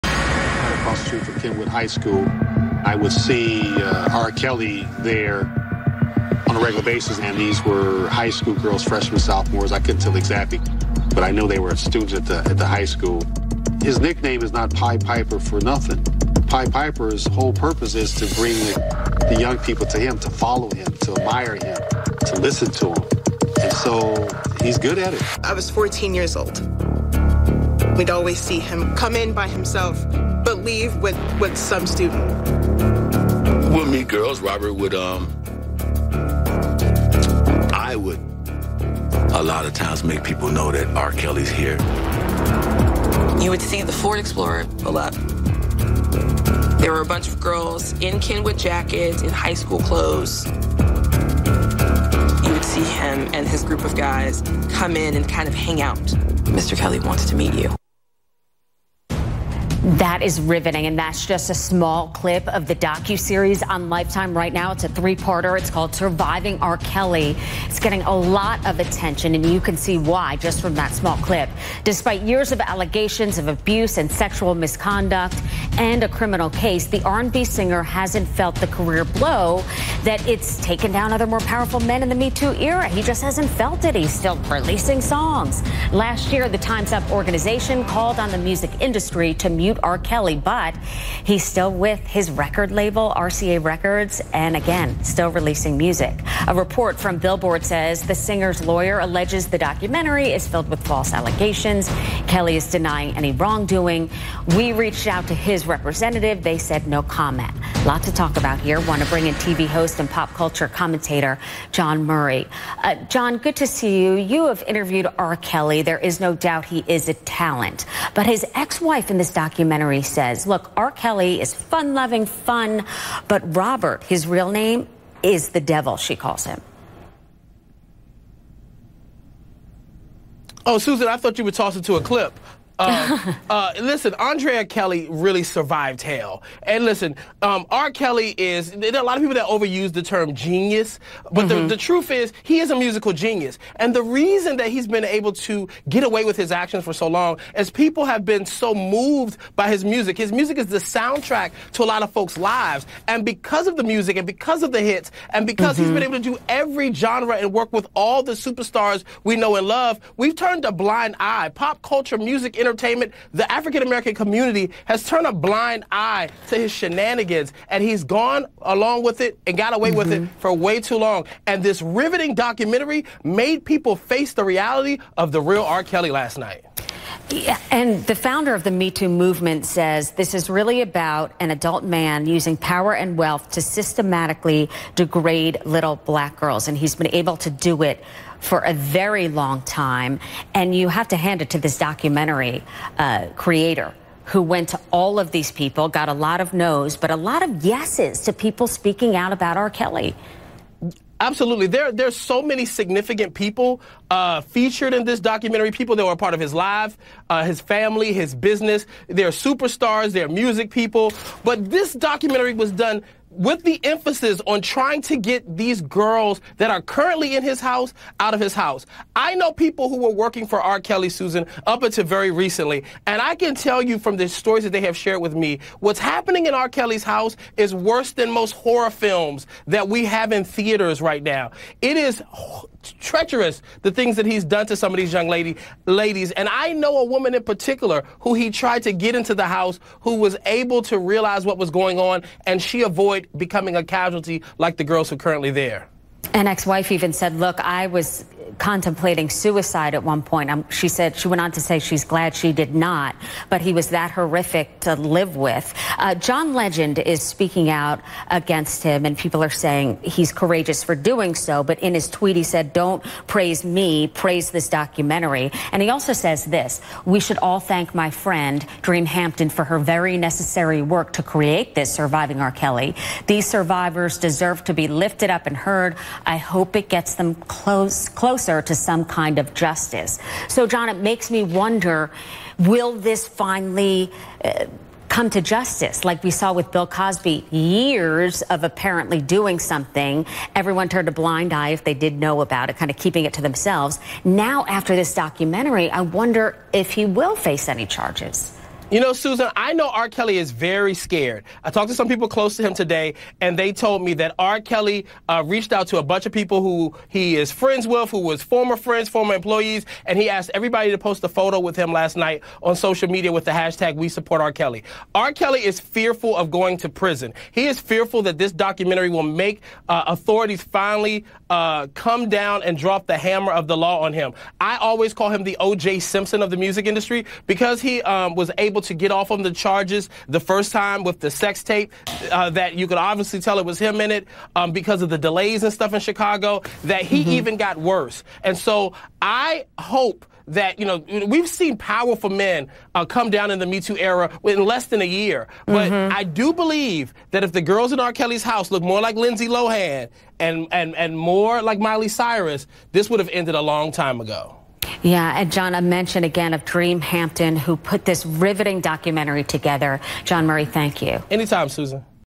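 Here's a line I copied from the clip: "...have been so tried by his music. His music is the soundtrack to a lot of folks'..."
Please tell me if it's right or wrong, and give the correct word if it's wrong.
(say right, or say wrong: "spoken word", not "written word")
wrong: "moved", not "tried".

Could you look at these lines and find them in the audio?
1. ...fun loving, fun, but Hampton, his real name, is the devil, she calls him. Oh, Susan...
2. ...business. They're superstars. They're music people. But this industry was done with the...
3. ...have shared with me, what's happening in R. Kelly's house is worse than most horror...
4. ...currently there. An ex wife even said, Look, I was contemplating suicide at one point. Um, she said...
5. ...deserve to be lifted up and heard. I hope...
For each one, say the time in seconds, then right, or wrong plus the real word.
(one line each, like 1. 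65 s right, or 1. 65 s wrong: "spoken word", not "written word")
1. 121 s wrong: "Robert", not "Hampton"
2. 208 s wrong: "documentary", not "industry"
3. 224 s right
4. 245 s right
5. 274 s right.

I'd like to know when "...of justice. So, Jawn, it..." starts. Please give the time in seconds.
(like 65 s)
279 s.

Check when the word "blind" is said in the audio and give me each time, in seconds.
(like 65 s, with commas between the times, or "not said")
160 s, 165 s, 291 s.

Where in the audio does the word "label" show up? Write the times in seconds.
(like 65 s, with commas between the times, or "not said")
92 s.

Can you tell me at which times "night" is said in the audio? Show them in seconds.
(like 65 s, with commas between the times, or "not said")
176 s, 312 s.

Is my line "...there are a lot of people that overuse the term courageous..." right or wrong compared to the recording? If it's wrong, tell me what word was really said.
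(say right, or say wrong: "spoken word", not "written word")
wrong: "genius", not "courageous".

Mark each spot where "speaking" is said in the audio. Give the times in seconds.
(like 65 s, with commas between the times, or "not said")
198 s, 257 s.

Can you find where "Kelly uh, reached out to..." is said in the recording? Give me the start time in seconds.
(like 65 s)
304 s.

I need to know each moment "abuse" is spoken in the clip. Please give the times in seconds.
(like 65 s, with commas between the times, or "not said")
73 s.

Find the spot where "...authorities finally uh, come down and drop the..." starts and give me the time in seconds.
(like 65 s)
320 s.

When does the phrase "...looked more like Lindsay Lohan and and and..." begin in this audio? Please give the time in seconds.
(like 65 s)
348 s.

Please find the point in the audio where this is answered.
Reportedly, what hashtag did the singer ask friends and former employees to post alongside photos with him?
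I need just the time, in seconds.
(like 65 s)
313 s.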